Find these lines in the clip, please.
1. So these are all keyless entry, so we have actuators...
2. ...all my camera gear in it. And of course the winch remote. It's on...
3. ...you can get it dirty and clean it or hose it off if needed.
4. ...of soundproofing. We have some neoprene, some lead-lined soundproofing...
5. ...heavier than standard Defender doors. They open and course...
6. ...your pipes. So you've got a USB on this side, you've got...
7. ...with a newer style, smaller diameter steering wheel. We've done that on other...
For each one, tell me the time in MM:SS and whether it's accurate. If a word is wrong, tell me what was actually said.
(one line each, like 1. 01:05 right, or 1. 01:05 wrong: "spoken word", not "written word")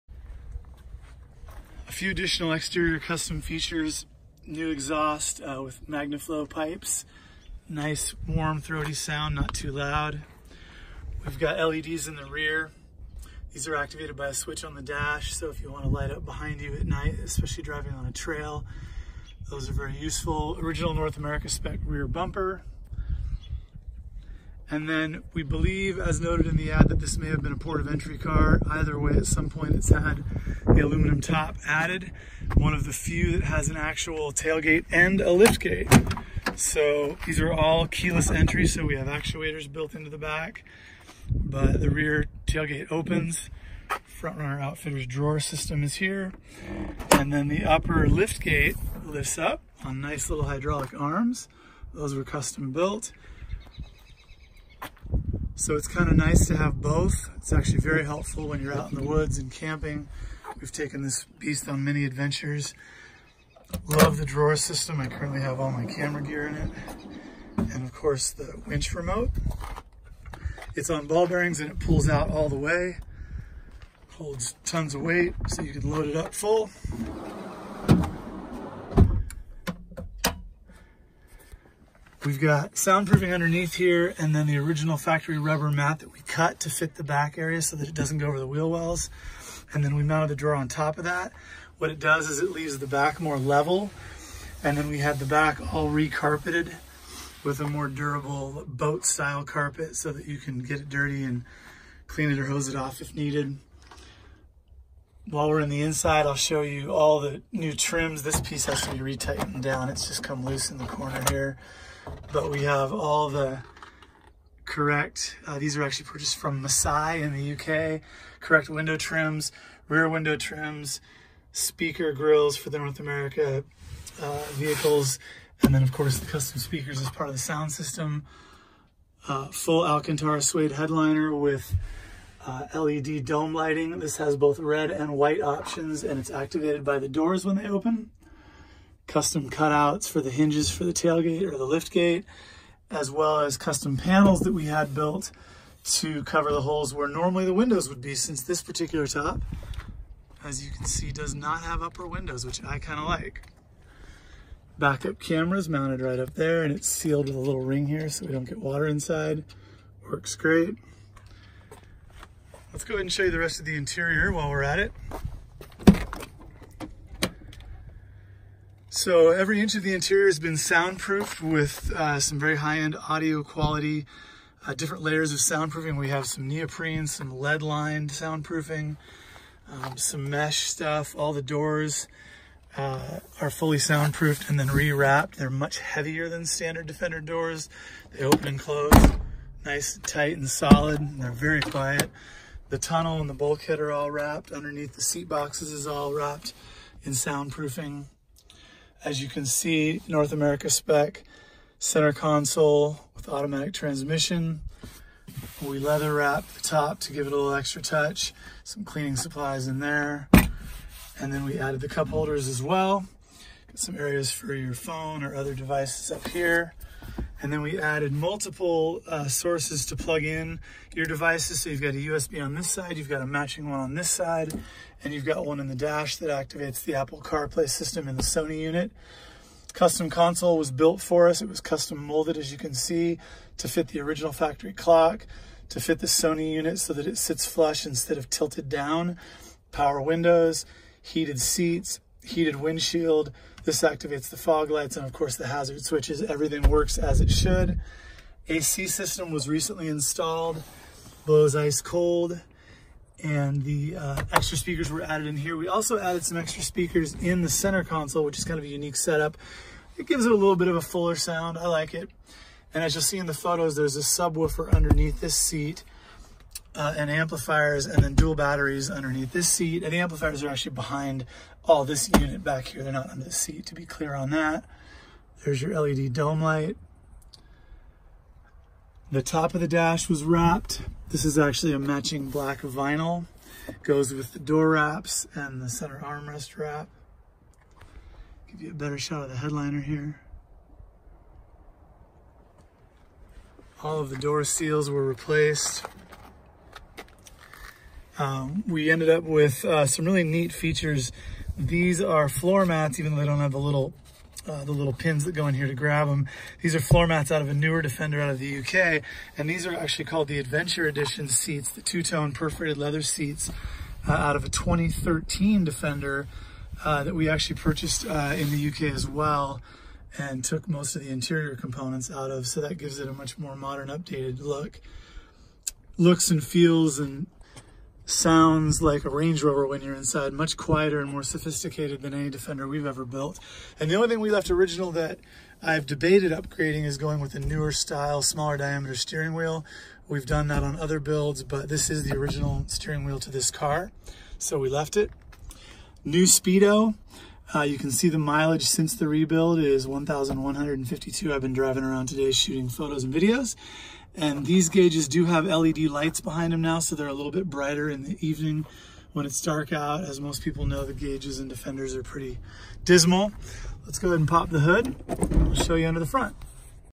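1. 00:36 right
2. 01:05 right
3. 01:40 right
4. 02:55 right
5. 03:05 wrong: "close", not "course"
6. 03:40 wrong: "devices", not "pipes"
7. 05:37 right.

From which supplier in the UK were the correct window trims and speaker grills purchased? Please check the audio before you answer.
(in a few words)
Masai.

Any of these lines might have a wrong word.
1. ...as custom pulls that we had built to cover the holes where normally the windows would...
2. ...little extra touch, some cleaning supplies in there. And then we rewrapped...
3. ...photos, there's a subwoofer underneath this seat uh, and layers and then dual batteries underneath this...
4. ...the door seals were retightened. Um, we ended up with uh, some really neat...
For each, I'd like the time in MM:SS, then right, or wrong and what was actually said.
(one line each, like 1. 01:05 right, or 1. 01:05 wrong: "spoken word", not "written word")
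1. 02:23 wrong: "panels", not "pulls"
2. 03:27 wrong: "added", not "rewrapped"
3. 04:23 wrong: "amplifiers", not "layers"
4. 04:54 wrong: "replaced", not "retightened".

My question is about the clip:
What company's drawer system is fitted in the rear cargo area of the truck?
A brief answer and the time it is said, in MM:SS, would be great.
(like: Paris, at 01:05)
Front Runner Outfitters, at 00:44.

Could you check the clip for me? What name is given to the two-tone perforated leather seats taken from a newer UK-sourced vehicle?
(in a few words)
Adventure Edition.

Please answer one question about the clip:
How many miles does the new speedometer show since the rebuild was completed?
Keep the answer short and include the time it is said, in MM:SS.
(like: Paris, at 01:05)
1,152, at 05:49.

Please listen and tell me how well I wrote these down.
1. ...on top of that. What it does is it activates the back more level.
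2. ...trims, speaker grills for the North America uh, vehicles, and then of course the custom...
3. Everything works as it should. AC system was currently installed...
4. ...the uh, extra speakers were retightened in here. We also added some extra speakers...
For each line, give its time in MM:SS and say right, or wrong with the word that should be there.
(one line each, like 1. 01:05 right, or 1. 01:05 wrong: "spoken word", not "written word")
1. 01:30 wrong: "leaves", not "activates"
2. 02:00 right
3. 04:06 wrong: "recently", not "currently"
4. 04:13 wrong: "added", not "retightened".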